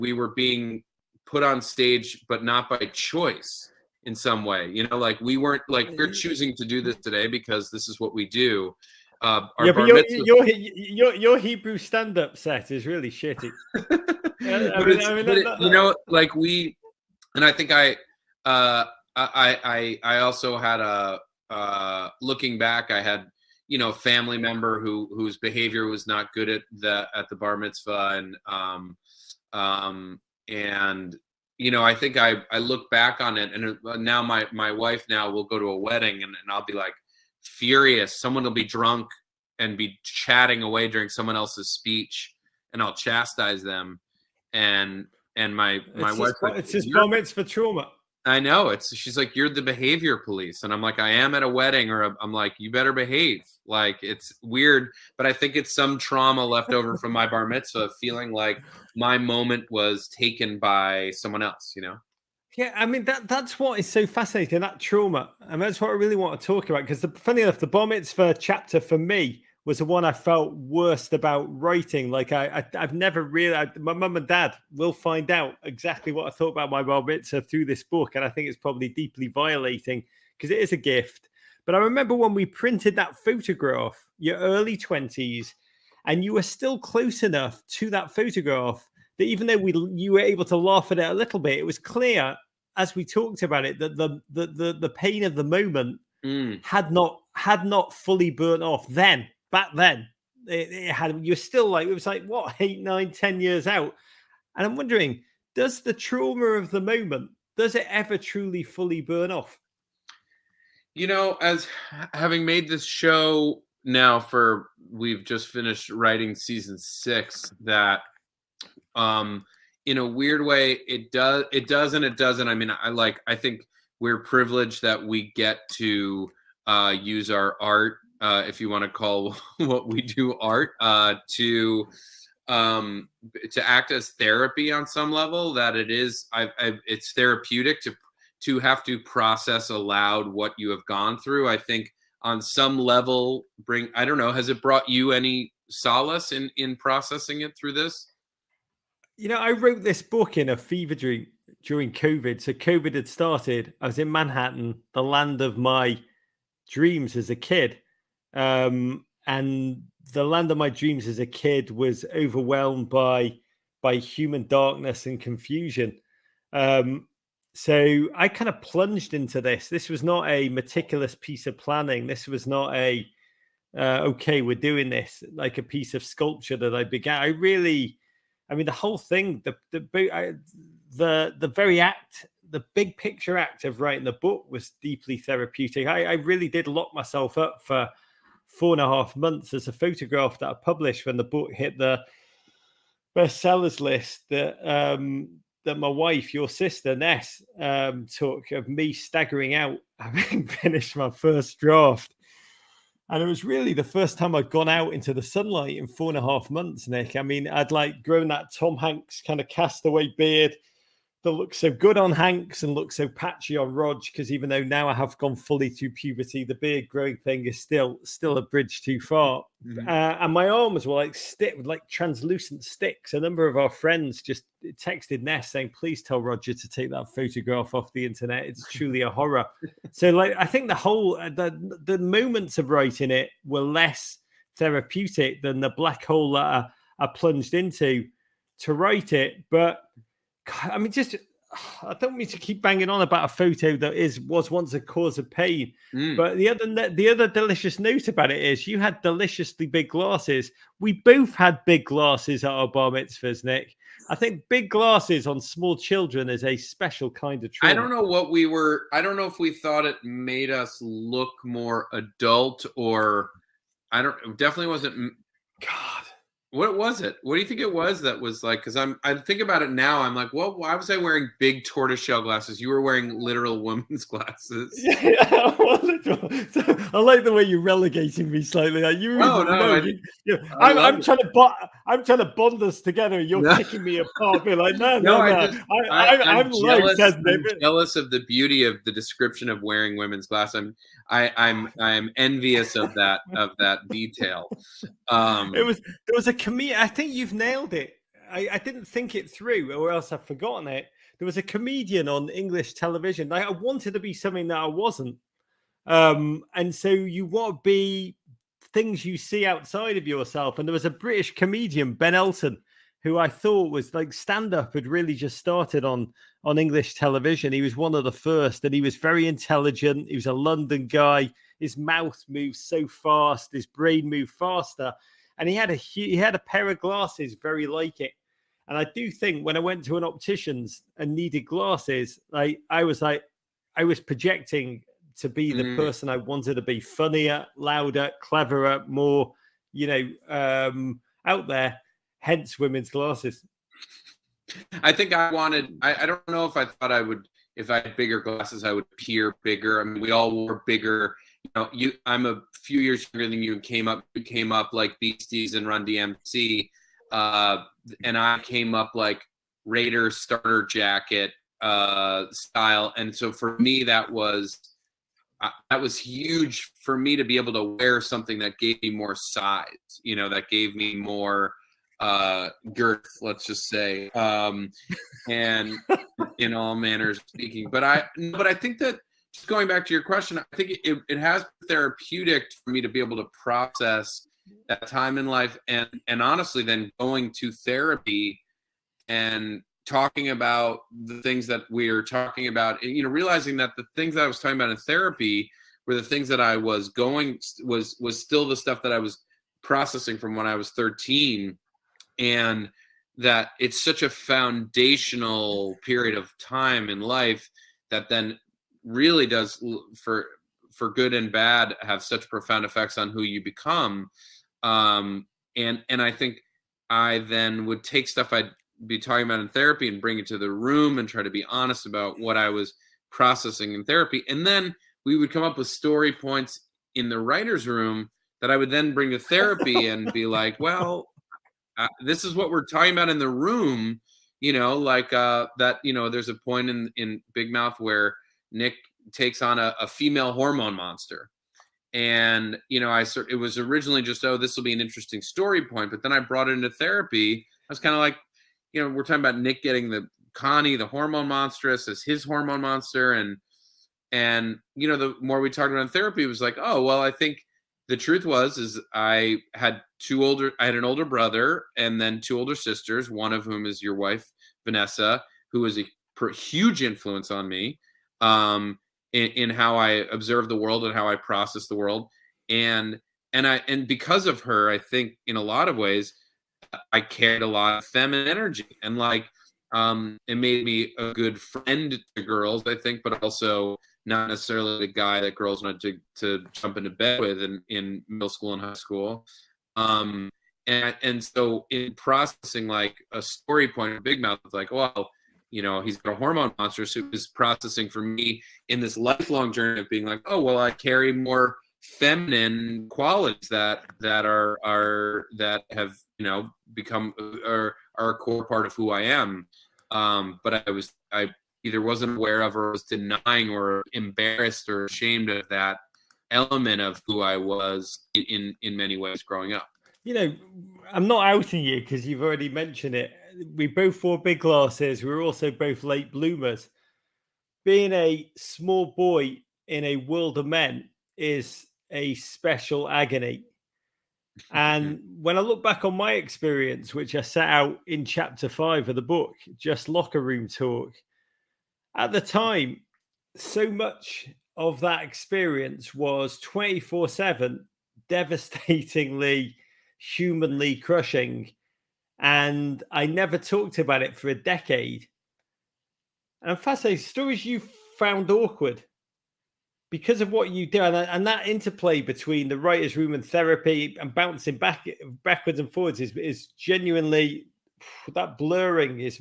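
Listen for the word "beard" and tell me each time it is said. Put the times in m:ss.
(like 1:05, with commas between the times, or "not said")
3:30, 3:36.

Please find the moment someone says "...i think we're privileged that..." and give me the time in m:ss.
2:03.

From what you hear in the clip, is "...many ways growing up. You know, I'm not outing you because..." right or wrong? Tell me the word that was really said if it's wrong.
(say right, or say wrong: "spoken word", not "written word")
right.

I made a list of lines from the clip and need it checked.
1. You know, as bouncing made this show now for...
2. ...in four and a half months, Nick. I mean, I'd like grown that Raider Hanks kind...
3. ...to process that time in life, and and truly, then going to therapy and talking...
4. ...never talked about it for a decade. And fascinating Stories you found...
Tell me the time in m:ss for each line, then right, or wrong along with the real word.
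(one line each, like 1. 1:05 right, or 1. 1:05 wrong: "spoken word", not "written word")
1. 1:50 wrong: "having", not "bouncing"
2. 3:25 wrong: "Tom", not "Raider"
3. 6:23 wrong: "honestly", not "truly"
4. 9:13 right.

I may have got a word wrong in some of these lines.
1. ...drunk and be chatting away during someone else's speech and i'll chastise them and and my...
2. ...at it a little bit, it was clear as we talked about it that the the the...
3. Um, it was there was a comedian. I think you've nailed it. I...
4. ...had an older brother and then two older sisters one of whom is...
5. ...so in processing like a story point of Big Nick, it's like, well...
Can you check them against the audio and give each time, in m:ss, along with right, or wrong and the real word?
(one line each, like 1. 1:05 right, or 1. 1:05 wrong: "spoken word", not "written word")
1. 0:38 right
2. 1:30 right
3. 4:55 right
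4. 7:40 right
5. 8:11 wrong: "Mouth", not "Nick".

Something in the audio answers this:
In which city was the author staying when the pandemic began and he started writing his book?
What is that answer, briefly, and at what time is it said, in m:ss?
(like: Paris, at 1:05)
Manhattan, at 2:34.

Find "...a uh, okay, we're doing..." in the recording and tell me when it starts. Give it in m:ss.
2:52.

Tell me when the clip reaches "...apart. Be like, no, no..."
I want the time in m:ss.
4:43.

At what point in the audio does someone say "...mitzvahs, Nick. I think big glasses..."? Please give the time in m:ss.
4:12.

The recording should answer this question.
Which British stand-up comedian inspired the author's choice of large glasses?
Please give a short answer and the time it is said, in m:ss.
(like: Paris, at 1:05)
Ben Elton, at 5:11.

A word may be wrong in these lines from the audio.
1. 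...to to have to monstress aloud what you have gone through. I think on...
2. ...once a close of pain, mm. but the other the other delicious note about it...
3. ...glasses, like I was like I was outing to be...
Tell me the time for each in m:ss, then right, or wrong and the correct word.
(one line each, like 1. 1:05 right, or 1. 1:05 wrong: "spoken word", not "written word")
1. 2:17 wrong: "process", not "monstress"
2. 4:04 wrong: "cause", not "close"
3. 5:31 wrong: "projecting", not "outing".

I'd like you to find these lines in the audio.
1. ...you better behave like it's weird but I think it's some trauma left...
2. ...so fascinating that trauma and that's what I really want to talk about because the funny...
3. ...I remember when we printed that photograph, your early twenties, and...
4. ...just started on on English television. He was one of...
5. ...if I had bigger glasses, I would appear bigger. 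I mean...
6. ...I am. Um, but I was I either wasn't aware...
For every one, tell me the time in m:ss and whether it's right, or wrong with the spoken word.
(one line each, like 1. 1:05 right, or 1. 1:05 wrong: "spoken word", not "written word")
1. 0:52 right
2. 1:03 right
3. 1:21 right
4. 5:15 right
5. 5:47 right
6. 8:28 right.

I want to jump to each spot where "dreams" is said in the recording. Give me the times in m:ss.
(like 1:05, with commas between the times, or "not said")
2:30, 2:36, 2:40.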